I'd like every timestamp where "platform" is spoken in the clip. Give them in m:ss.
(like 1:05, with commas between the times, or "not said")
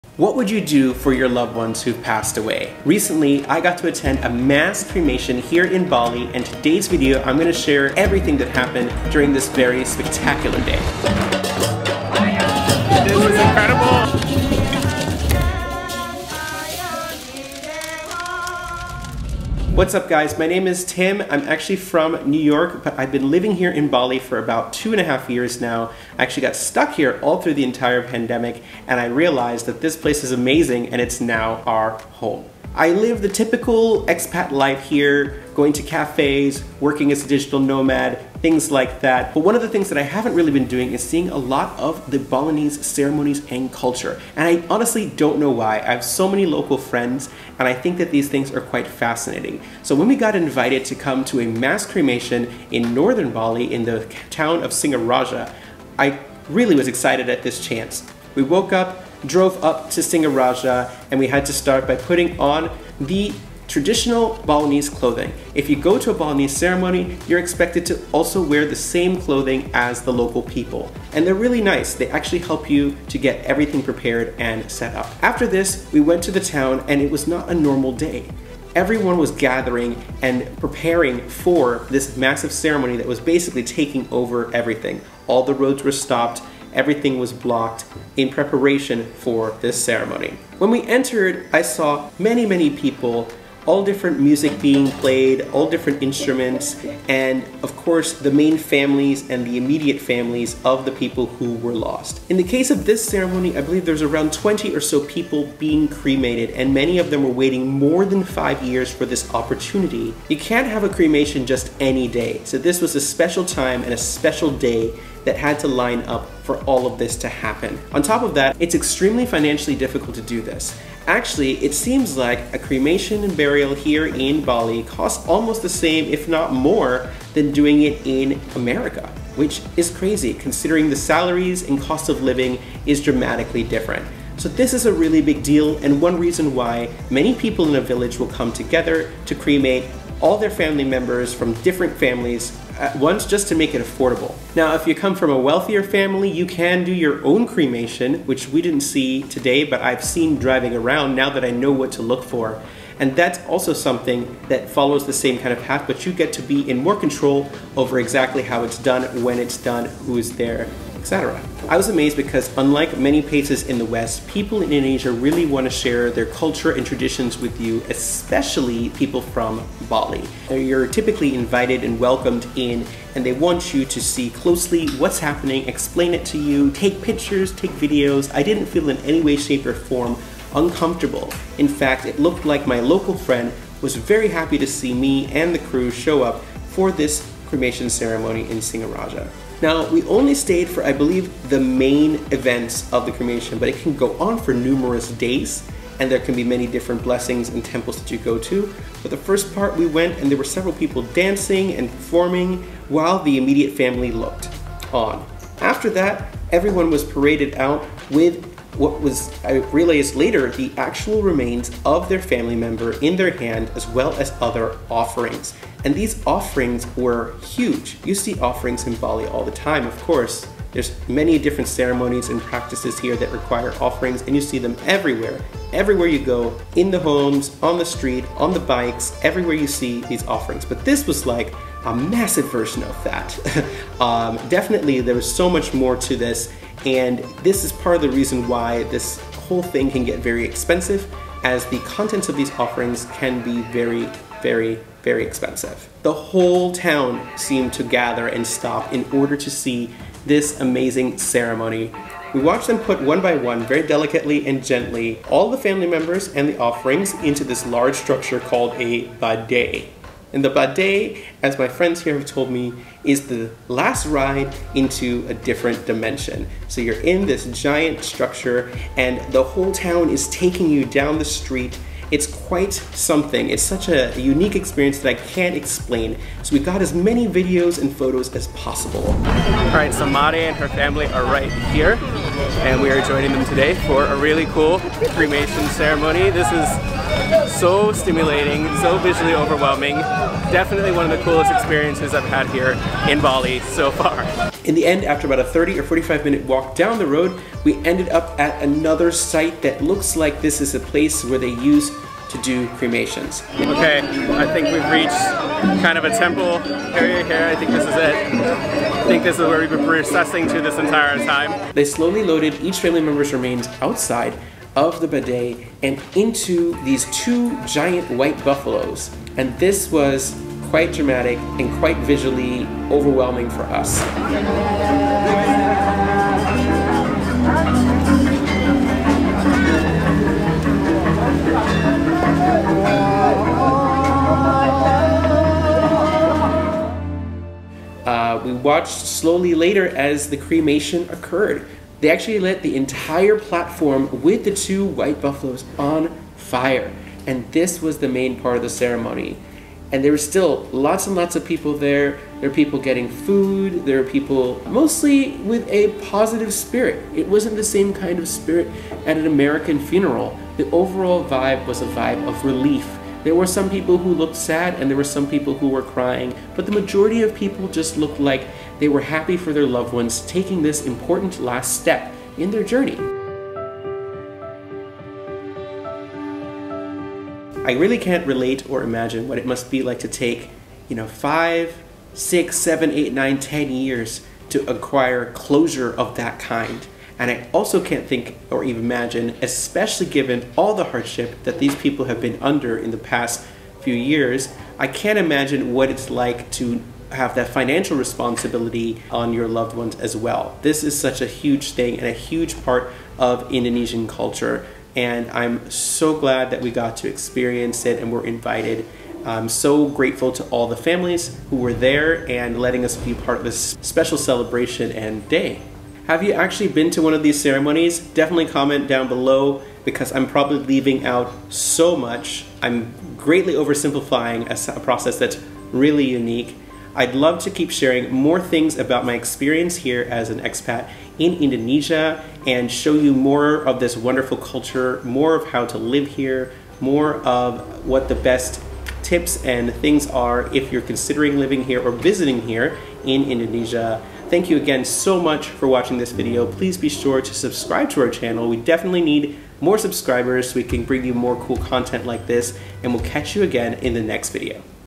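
5:43.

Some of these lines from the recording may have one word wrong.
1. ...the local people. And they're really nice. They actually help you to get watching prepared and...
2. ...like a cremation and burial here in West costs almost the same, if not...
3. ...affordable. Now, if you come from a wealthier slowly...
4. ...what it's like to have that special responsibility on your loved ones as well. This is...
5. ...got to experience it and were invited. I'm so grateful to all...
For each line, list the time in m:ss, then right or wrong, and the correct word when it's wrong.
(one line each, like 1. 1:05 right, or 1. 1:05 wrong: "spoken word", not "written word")
1. 1:10 wrong: "everything", not "watching"
2. 2:02 wrong: "Bali", not "West"
3. 2:23 wrong: "family", not "slowly"
4. 6:35 wrong: "financial", not "special"
5. 6:46 right.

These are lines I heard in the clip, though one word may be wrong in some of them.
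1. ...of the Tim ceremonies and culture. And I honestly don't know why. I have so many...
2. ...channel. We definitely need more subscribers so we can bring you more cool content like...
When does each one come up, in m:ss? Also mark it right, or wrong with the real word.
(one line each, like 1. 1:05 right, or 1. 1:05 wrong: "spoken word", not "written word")
1. 0:41 wrong: "Balinese", not "Tim"
2. 7:28 right.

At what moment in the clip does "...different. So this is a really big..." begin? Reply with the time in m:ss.
2:13.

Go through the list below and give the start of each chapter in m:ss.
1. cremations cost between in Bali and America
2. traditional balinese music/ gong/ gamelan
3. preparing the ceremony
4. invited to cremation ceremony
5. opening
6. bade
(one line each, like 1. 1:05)
1. 2:10
2. 1:35
3. 1:20
4. 0:53
5. 0:20
6. 4:21.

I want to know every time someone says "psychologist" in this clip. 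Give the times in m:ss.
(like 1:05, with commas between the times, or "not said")
not said.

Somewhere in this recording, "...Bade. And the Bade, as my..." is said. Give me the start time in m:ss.
4:19.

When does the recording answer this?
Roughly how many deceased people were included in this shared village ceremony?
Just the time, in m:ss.
1:44.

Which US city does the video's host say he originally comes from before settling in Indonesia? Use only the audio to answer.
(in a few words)
New York.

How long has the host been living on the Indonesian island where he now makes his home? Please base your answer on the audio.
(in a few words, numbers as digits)
two and a half years.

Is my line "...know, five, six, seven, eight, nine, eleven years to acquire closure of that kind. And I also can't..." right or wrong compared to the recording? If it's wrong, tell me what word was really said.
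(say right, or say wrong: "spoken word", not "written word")
wrong: "ten", not "eleven".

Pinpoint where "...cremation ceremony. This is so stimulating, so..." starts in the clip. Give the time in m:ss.
4:45.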